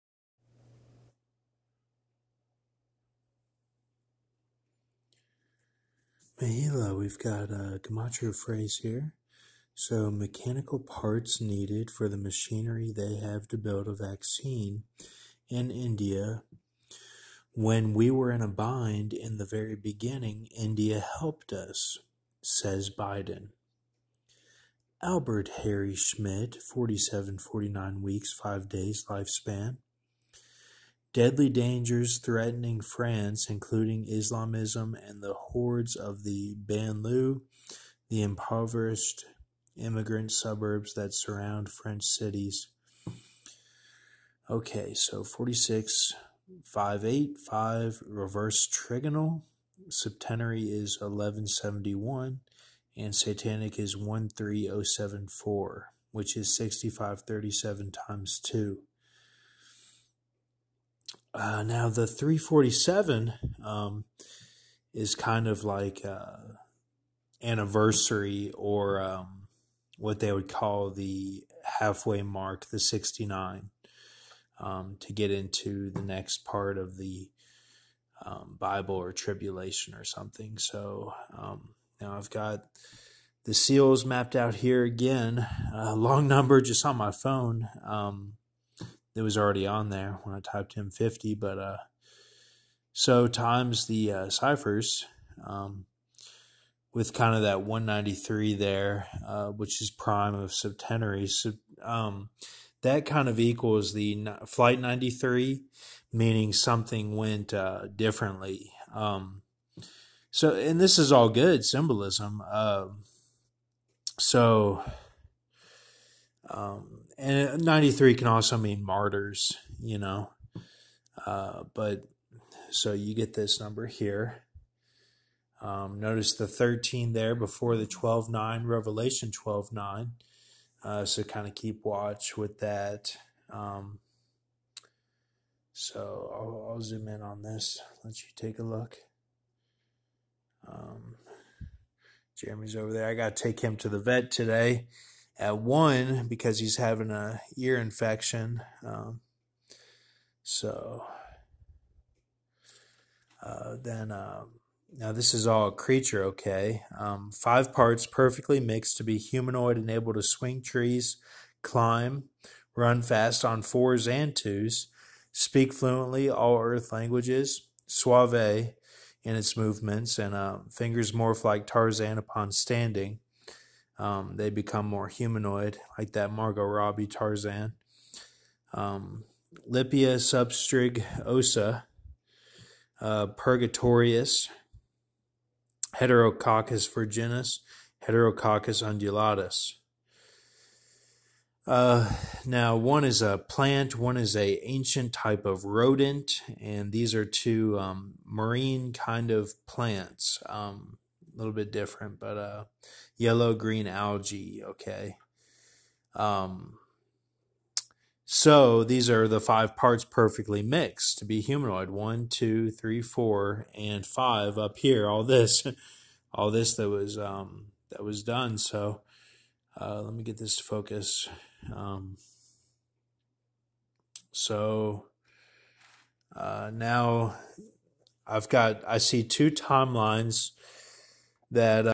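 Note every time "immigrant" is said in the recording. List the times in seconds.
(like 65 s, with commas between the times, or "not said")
39 s.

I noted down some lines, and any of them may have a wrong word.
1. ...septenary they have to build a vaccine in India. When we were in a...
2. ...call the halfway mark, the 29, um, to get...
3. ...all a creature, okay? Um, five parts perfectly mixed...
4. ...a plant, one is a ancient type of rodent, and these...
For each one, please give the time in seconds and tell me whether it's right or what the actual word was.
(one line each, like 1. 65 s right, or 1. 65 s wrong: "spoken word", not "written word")
1. 12 s wrong: "machinery", not "septenary"
2. 70 s wrong: "69", not "29"
3. 155 s right
4. 193 s right.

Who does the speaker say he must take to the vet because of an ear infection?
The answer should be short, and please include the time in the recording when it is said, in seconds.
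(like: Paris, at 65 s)
Jeremy, at 142 s.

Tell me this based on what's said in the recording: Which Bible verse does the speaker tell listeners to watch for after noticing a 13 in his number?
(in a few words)
Revelation 12:9.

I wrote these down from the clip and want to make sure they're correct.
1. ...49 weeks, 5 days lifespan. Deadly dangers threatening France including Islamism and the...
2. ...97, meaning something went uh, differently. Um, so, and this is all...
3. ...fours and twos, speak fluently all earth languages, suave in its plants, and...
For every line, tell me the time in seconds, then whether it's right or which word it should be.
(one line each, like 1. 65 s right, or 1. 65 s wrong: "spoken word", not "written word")
1. 27 s right
2. 104 s wrong: "93", not "97"
3. 163 s wrong: "movements", not "plants".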